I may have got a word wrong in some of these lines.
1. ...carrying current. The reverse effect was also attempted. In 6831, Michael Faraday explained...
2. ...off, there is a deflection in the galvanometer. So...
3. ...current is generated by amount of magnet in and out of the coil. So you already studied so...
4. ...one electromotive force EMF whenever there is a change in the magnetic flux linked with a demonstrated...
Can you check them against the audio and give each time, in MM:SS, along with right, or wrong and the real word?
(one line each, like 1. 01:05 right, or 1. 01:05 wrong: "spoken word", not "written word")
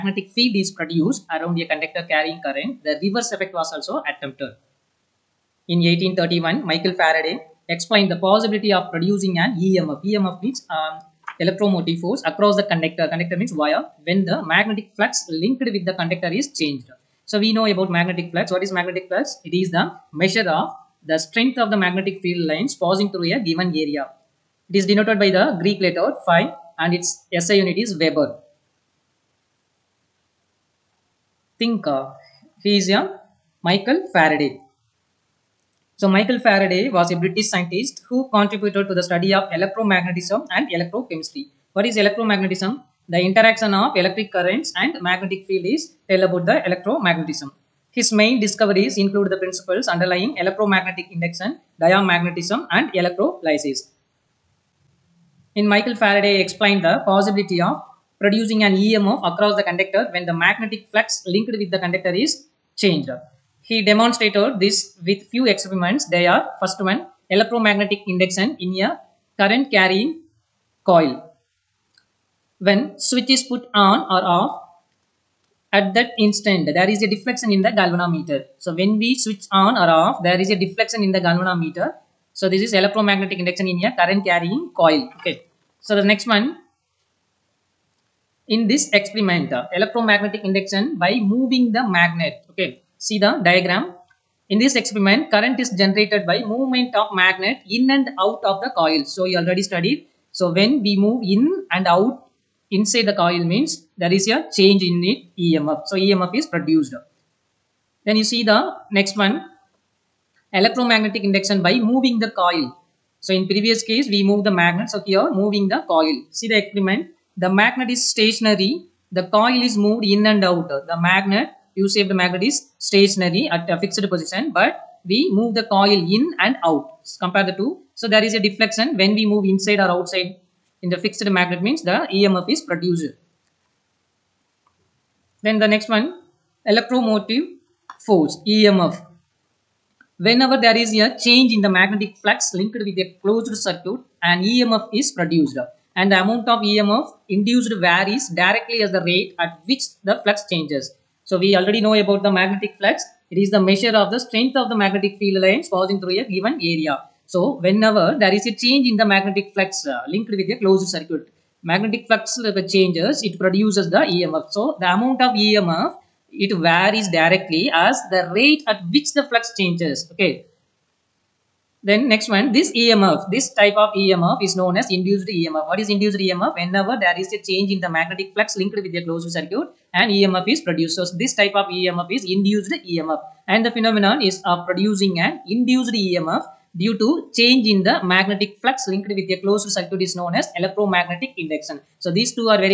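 1. 00:02 wrong: "1831", not "6831"
2. 01:20 right
3. 01:35 wrong: "movement", not "amount"
4. 02:15 wrong: "closed", not "demonstrated".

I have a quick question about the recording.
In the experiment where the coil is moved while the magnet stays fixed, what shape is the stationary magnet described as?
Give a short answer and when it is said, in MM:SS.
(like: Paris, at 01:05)
U-shaped, at 02:01.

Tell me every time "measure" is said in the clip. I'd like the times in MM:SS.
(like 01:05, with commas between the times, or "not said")
00:20, 02:33.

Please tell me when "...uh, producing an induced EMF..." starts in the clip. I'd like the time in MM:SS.
03:04.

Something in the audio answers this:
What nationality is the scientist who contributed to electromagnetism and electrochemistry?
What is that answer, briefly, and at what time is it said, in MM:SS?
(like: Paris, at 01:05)
British, at 00:37.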